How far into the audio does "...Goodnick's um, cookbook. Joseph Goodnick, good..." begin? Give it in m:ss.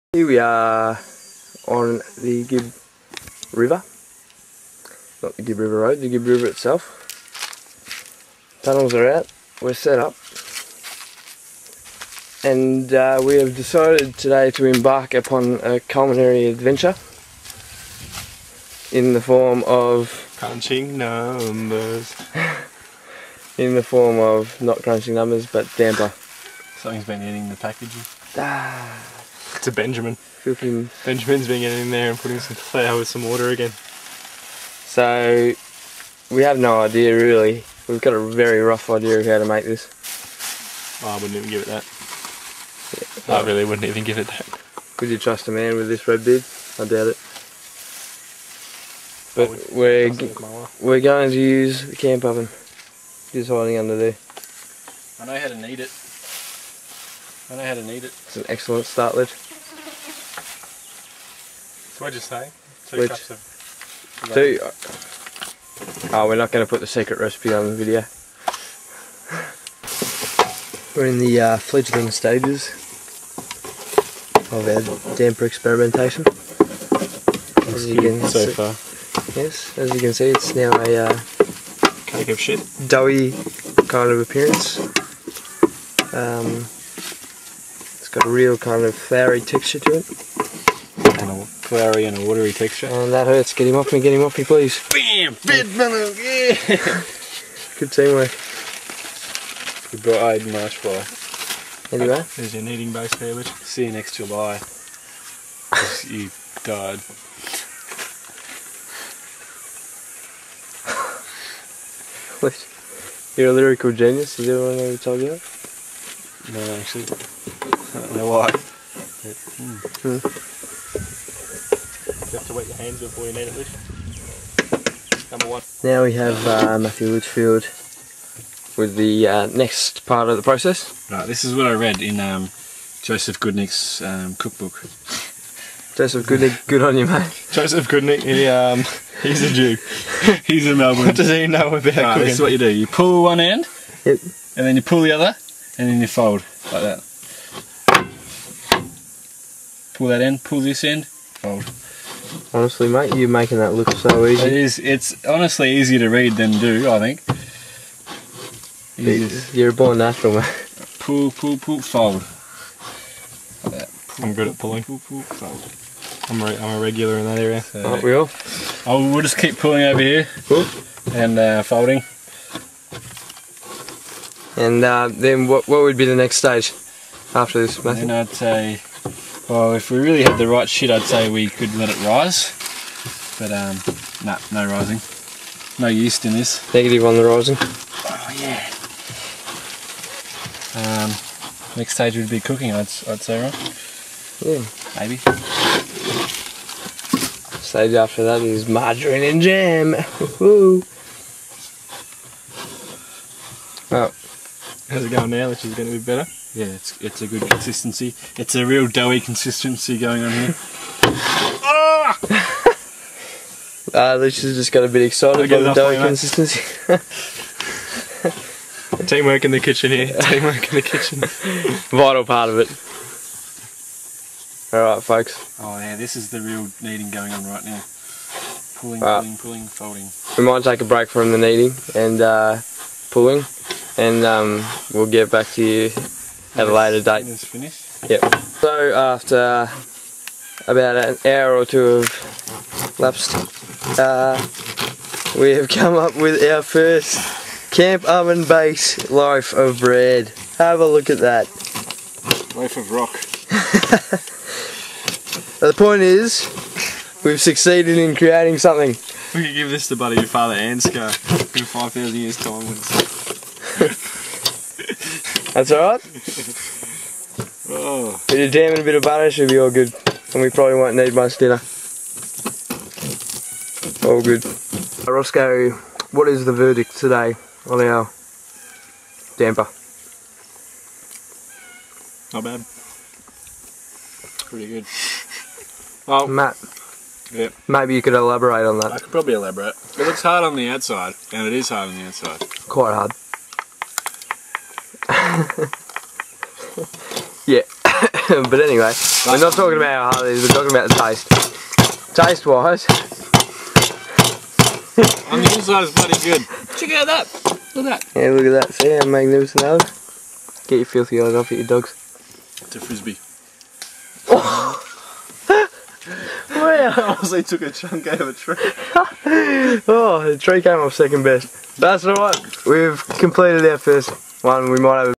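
2:13.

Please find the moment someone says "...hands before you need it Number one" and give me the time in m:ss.
2:02.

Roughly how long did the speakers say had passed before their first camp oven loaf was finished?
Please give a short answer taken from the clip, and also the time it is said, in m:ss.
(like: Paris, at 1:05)
An hour or two, at 4:00.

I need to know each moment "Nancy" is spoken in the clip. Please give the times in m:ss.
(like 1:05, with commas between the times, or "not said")
not said.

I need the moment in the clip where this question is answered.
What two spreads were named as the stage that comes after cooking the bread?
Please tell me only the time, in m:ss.
3:18.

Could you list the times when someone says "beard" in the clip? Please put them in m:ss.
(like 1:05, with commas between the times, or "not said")
0:46.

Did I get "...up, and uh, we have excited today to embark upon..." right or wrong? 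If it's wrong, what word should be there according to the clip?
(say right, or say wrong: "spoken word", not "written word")
wrong: "decided", not "excited".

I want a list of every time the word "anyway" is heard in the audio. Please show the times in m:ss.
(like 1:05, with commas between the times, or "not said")
1:41, 4:58.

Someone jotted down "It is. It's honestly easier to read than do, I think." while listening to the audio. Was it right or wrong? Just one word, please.
right.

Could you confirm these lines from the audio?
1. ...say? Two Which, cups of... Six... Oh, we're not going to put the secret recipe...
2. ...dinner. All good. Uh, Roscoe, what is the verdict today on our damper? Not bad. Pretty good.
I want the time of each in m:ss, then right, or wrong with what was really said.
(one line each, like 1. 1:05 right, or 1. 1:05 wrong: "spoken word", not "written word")
1. 1:02 wrong: "Two", not "Six"
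2. 4:31 right.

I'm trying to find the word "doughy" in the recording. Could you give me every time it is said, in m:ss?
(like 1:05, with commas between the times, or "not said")
1:22, 3:28, 3:35.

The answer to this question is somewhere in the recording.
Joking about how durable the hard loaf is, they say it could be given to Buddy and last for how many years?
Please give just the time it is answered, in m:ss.
4:21.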